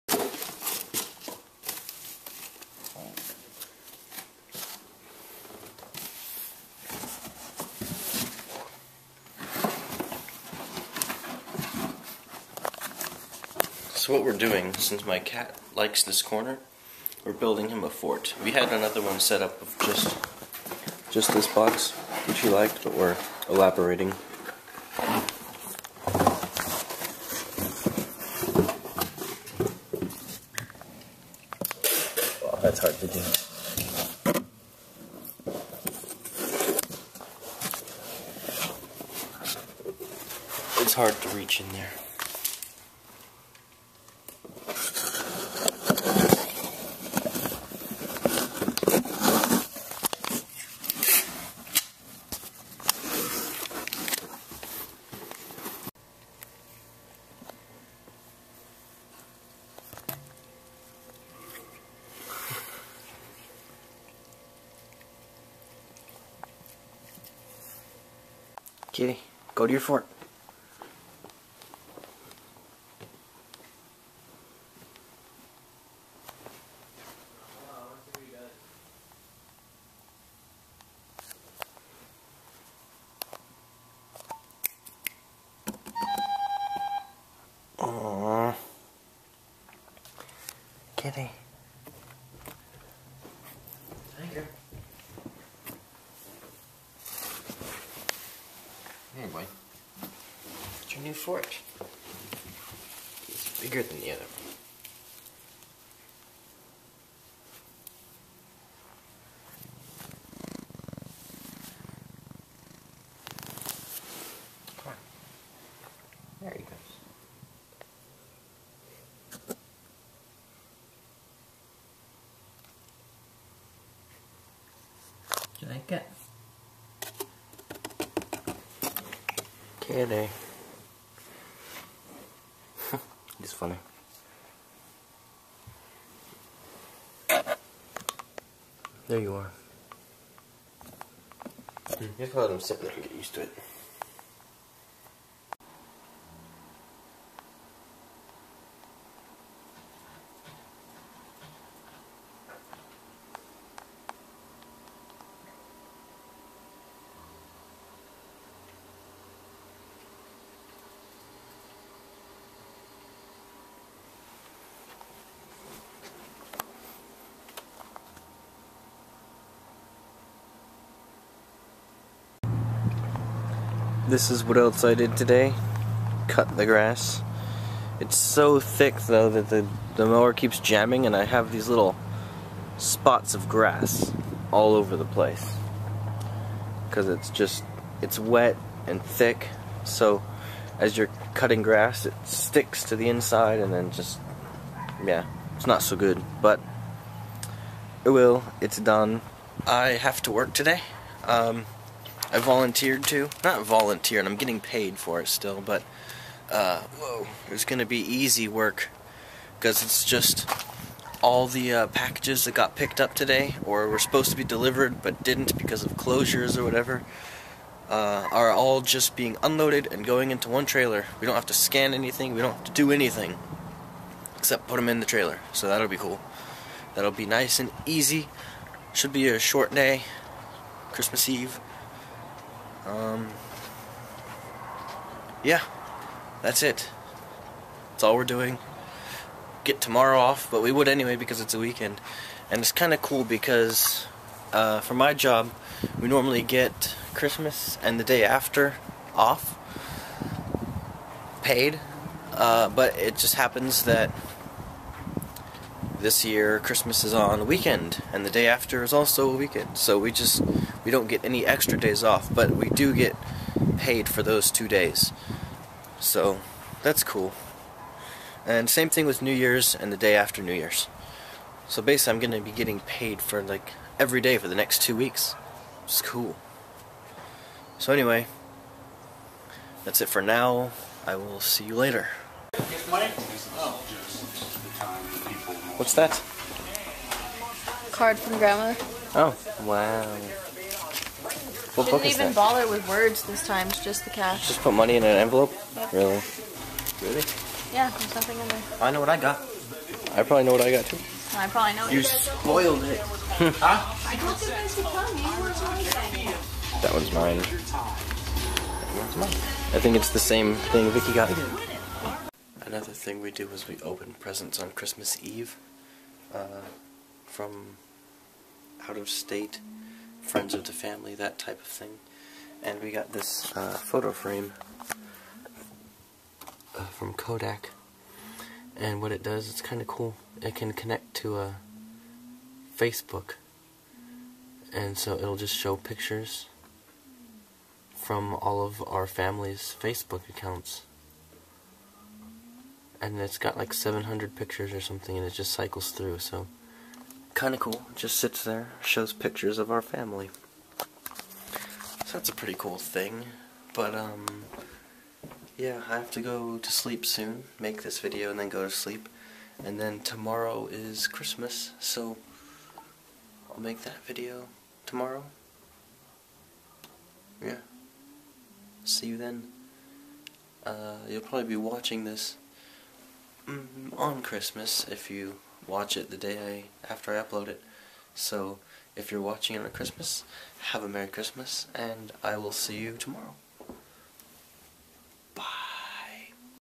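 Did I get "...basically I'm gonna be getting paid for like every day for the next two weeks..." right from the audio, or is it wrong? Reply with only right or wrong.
right.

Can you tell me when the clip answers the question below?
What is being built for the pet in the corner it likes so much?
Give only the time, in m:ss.
0:17.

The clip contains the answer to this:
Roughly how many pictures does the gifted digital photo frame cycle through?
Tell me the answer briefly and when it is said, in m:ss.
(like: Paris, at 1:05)
700, at 5:43.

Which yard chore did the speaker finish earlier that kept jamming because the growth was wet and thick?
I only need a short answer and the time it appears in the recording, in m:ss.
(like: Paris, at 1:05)
Cut the grass, at 2:56.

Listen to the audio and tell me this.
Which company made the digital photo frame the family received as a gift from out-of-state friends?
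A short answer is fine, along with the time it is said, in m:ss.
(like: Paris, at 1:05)
Kodak, at 5:27.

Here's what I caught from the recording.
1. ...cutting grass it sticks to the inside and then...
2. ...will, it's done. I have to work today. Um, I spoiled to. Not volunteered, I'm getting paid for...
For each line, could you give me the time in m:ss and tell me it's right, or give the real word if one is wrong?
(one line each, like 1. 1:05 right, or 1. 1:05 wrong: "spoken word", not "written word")
1. 3:11 right
2. 3:18 wrong: "volunteered", not "spoiled".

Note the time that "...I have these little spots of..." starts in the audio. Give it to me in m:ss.
3:01.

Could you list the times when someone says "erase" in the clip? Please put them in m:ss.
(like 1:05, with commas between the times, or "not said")
not said.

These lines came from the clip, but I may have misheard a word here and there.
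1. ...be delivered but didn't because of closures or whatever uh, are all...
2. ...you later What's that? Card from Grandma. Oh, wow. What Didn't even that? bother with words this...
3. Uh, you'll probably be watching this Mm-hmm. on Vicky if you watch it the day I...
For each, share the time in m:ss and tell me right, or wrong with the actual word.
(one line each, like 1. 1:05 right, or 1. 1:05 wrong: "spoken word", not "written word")
1. 3:34 right
2. 4:41 right
3. 6:10 wrong: "Christmas", not "Vicky".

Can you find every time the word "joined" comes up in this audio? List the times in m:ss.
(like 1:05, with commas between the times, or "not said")
not said.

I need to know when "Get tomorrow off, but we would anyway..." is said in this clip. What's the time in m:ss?
3:59.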